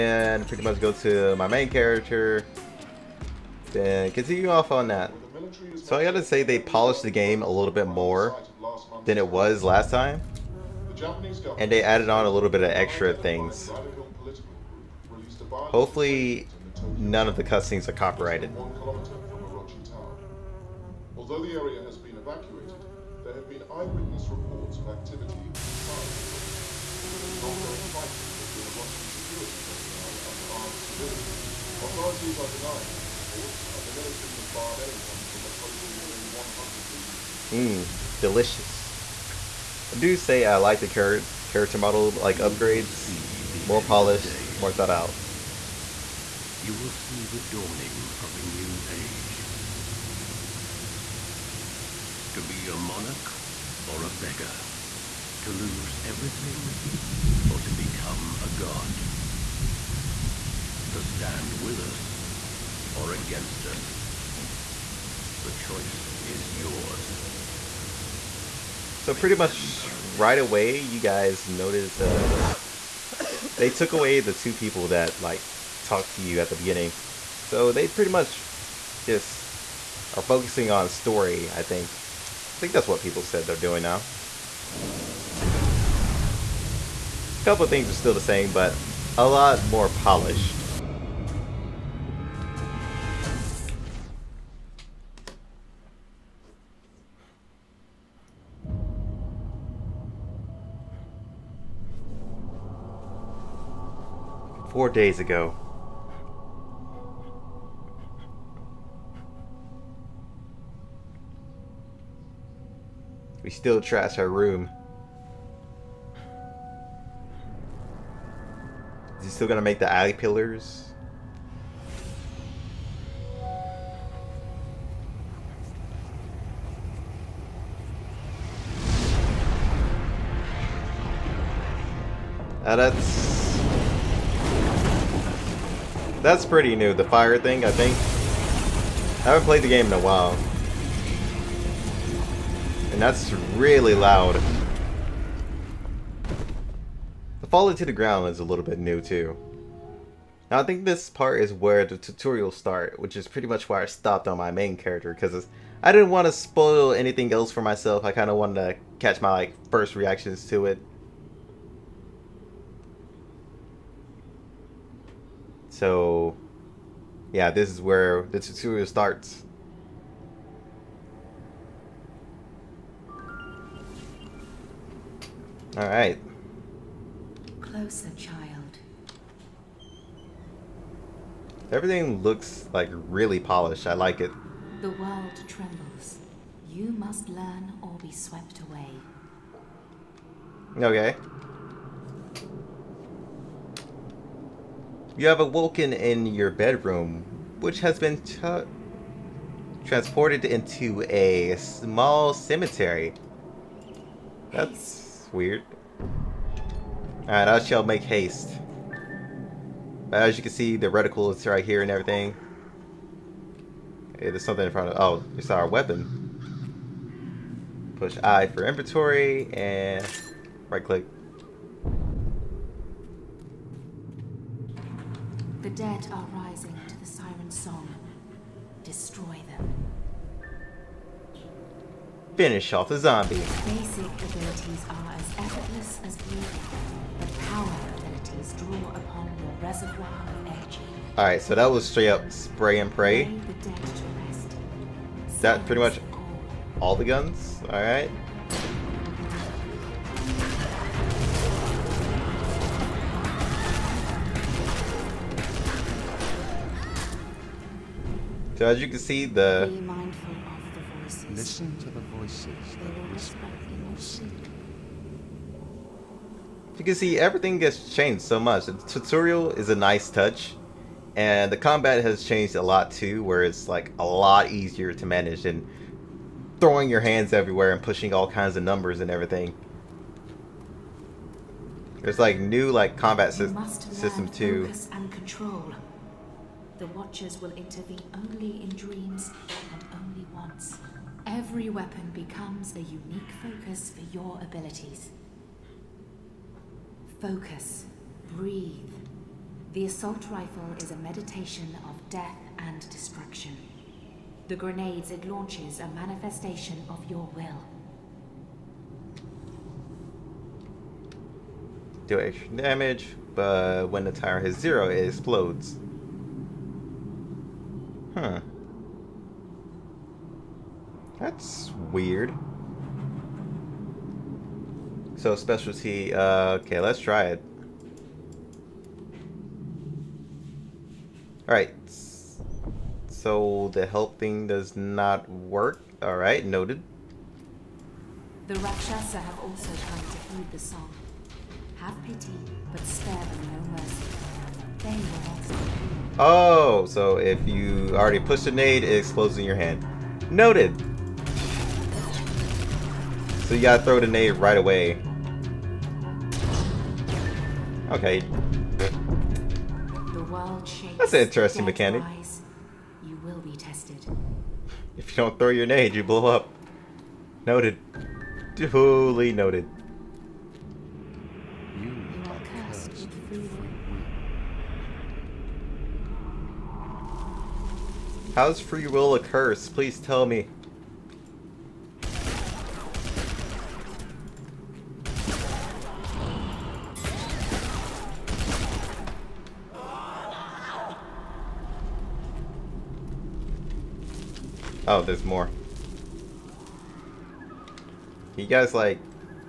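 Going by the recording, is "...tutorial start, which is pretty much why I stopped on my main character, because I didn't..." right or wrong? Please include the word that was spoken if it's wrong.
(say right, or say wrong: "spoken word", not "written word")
right.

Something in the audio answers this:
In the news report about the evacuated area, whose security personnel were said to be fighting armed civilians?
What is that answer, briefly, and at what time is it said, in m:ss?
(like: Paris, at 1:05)
Orochi, at 0:28.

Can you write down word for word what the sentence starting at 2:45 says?
So, yeah, this is where the tutorial starts.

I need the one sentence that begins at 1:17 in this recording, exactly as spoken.
So they pretty much just are focusing on story.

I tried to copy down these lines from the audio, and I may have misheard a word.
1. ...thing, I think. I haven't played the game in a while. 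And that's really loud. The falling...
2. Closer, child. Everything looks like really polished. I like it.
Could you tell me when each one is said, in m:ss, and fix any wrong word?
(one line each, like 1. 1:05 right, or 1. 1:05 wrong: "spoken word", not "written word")
1. 2:17 right
2. 2:57 right.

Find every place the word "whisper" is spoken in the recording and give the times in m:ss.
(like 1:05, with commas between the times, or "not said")
4:23.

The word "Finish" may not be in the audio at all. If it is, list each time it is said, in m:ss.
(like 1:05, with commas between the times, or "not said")
3:52.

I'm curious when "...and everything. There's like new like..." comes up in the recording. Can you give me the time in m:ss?
4:38.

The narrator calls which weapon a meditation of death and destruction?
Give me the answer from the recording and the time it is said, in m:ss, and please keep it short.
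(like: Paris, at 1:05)
The assault rifle, at 4:59.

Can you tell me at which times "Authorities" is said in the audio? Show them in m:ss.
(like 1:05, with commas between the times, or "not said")
0:31.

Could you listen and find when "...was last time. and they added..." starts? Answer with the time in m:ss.
0:09.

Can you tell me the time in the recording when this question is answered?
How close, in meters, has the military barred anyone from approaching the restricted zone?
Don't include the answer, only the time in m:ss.
0:36.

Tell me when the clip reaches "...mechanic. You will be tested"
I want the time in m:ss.
6:01.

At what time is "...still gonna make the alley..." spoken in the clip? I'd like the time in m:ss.
1:59.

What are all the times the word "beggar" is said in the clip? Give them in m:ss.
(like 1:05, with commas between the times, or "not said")
0:54.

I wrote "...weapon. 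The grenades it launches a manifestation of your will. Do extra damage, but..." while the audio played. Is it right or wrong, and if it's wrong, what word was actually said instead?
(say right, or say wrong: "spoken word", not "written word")
wrong: "destruction", not "weapon".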